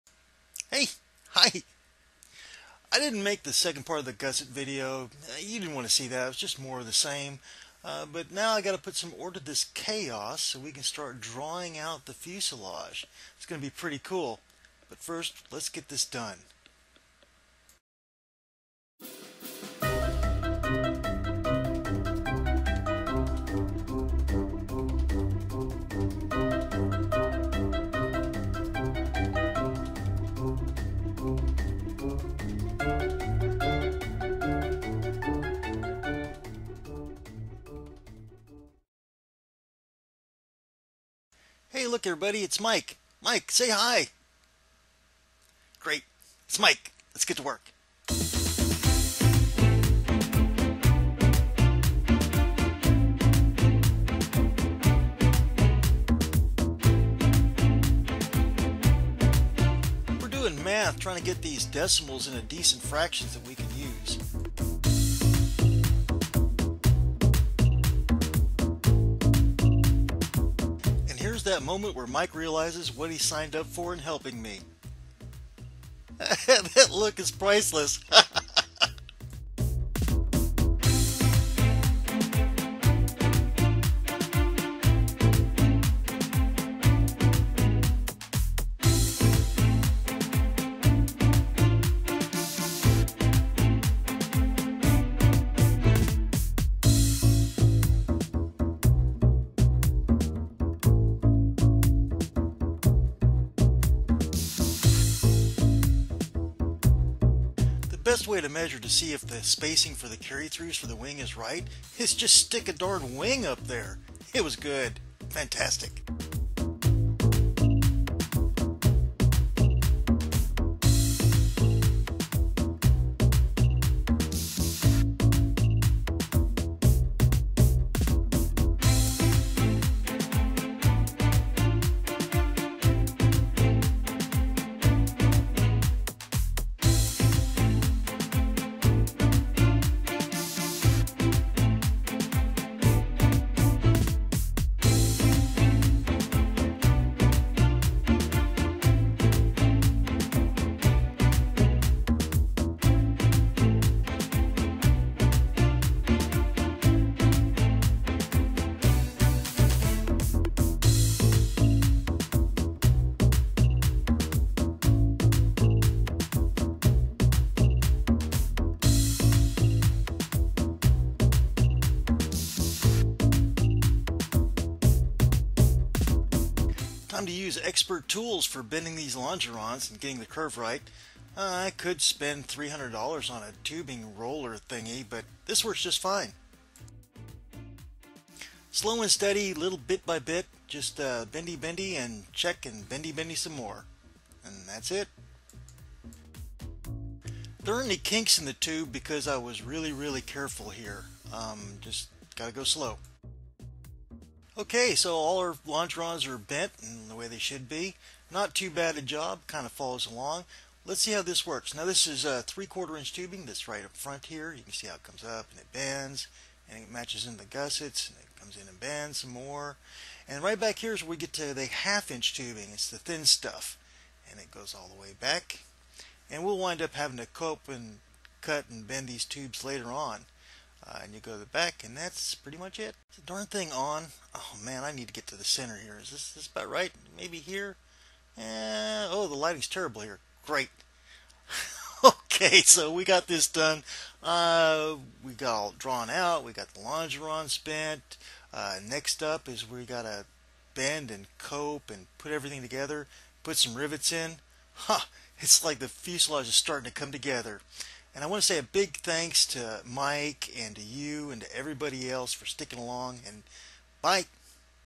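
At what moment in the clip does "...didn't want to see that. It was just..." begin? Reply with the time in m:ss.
0:05.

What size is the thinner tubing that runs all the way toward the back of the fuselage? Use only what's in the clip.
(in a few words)
1/2 inch.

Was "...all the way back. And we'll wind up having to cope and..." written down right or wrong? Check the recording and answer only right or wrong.
right.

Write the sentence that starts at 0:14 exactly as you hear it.
But first, let's get this done.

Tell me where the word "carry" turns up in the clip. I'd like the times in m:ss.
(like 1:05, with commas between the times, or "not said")
1:50.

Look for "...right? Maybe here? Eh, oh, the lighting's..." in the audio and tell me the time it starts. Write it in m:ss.
3:56.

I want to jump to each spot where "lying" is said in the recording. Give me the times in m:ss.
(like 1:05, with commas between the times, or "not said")
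not said.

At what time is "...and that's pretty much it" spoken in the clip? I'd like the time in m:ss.
3:51.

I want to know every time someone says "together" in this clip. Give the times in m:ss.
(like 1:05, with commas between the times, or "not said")
4:12, 4:17.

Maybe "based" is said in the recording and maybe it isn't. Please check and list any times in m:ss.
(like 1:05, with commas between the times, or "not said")
not said.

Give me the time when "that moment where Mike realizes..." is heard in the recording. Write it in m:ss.
1:11.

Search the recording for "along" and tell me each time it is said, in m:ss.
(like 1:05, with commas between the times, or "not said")
3:30, 4:22.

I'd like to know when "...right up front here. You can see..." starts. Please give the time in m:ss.
3:33.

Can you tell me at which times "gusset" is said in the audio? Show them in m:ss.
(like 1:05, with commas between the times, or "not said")
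0:04, 3:37.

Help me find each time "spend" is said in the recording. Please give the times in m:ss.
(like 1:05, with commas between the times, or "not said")
3:02.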